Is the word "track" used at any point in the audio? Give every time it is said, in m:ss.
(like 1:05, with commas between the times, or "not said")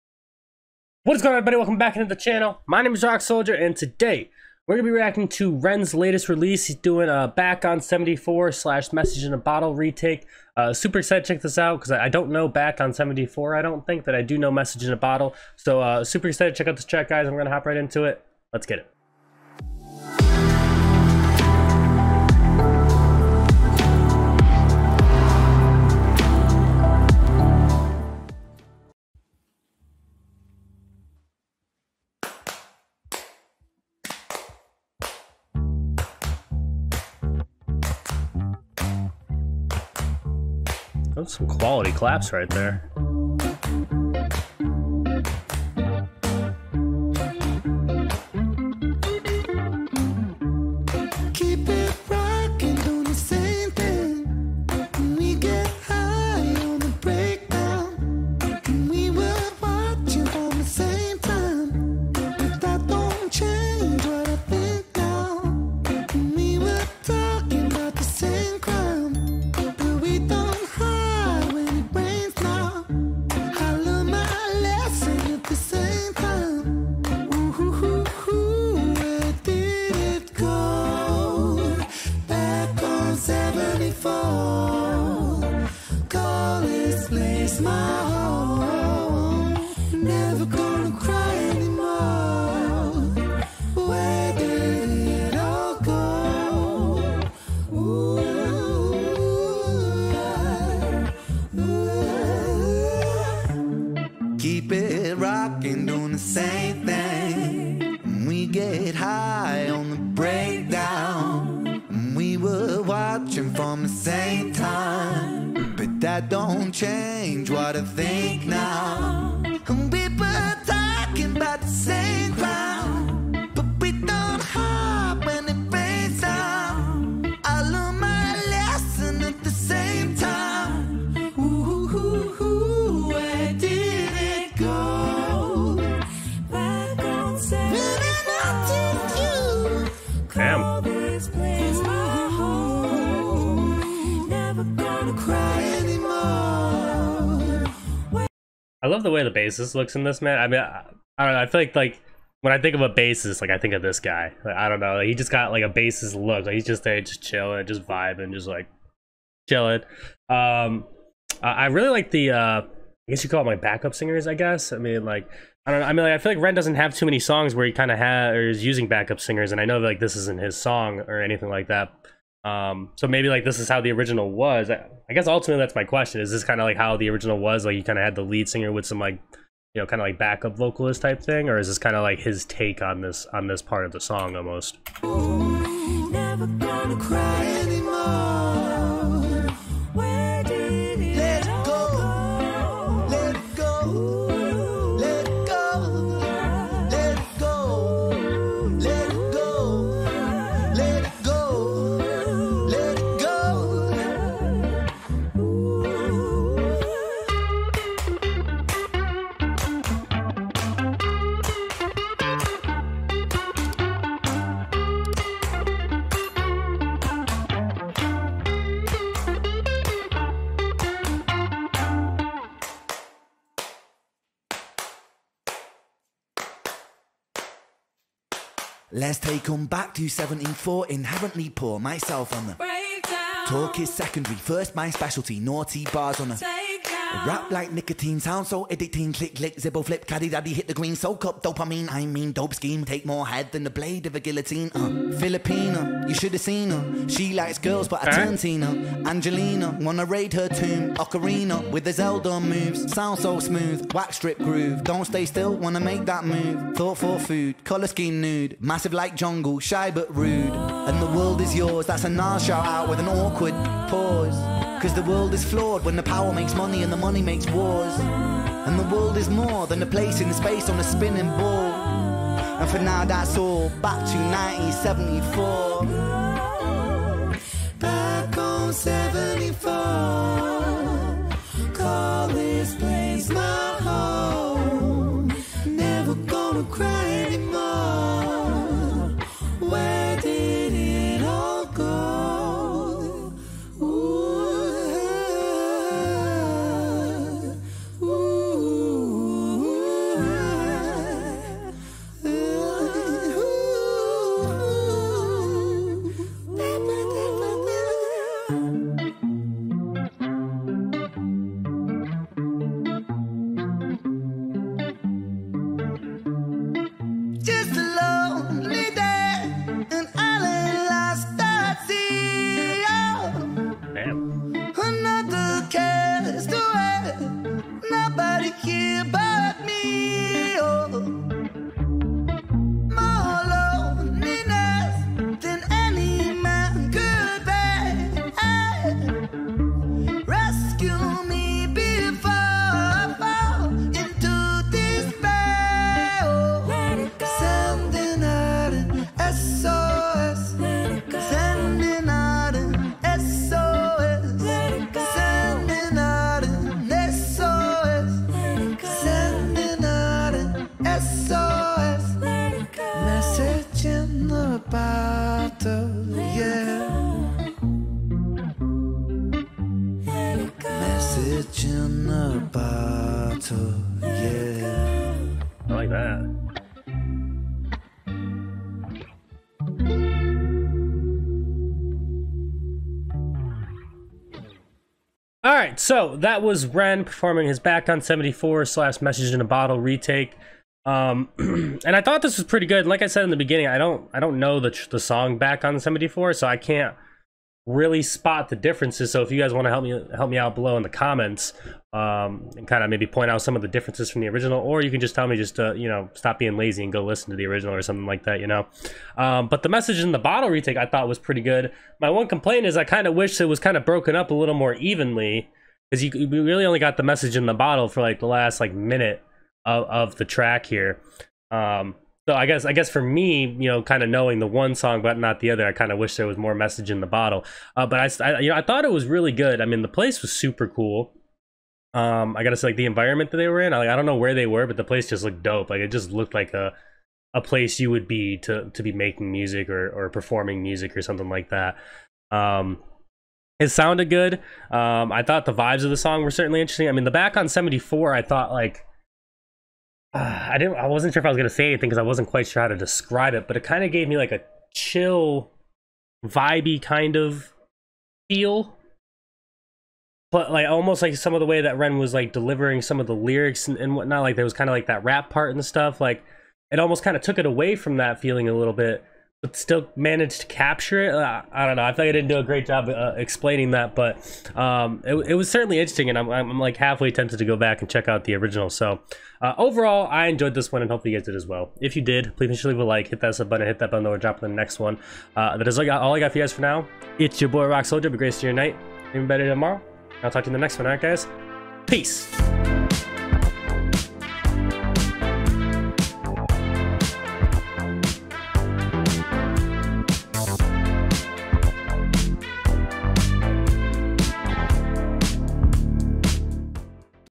0:16, 7:00.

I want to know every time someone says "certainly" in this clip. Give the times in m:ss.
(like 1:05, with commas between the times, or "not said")
7:26, 7:55.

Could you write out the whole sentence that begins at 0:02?
My name is Roc Soldier and today we're going to be reacting to Ren's latest release.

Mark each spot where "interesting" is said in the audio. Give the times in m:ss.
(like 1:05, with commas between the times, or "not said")
7:26, 7:55.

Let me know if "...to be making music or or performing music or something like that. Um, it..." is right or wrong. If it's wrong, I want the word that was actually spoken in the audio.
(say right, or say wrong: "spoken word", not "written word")
right.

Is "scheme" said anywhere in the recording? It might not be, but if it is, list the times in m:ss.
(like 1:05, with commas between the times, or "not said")
4:02, 4:17.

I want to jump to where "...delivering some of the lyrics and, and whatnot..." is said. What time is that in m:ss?
7:42.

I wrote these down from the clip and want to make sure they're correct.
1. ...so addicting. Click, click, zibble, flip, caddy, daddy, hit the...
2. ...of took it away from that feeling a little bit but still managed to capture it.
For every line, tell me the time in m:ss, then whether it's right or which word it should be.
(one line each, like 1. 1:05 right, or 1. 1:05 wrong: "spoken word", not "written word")
1. 3:58 right
2. 7:47 right.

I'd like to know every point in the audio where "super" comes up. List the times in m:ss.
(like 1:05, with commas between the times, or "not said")
0:10, 0:16, 7:10.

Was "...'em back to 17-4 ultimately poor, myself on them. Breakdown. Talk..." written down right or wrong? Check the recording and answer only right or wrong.
wrong.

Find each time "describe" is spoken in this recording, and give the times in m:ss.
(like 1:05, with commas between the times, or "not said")
7:32.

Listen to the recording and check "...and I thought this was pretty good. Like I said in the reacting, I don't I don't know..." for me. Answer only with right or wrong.
wrong.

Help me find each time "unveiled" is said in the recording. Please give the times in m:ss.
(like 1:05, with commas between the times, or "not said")
not said.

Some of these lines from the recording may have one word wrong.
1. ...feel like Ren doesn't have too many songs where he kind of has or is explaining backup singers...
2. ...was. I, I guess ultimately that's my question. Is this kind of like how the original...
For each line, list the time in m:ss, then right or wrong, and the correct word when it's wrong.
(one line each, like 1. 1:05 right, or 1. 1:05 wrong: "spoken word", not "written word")
1. 2:46 wrong: "using", not "explaining"
2. 2:54 right.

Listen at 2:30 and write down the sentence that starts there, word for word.
I mean, I, I, don't know.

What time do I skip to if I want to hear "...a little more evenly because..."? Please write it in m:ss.
6:54.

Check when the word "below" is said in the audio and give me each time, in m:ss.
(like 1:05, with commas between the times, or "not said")
6:40.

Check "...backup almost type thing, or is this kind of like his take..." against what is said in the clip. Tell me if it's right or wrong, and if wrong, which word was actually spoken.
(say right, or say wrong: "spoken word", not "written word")
wrong: "vocalist", not "almost".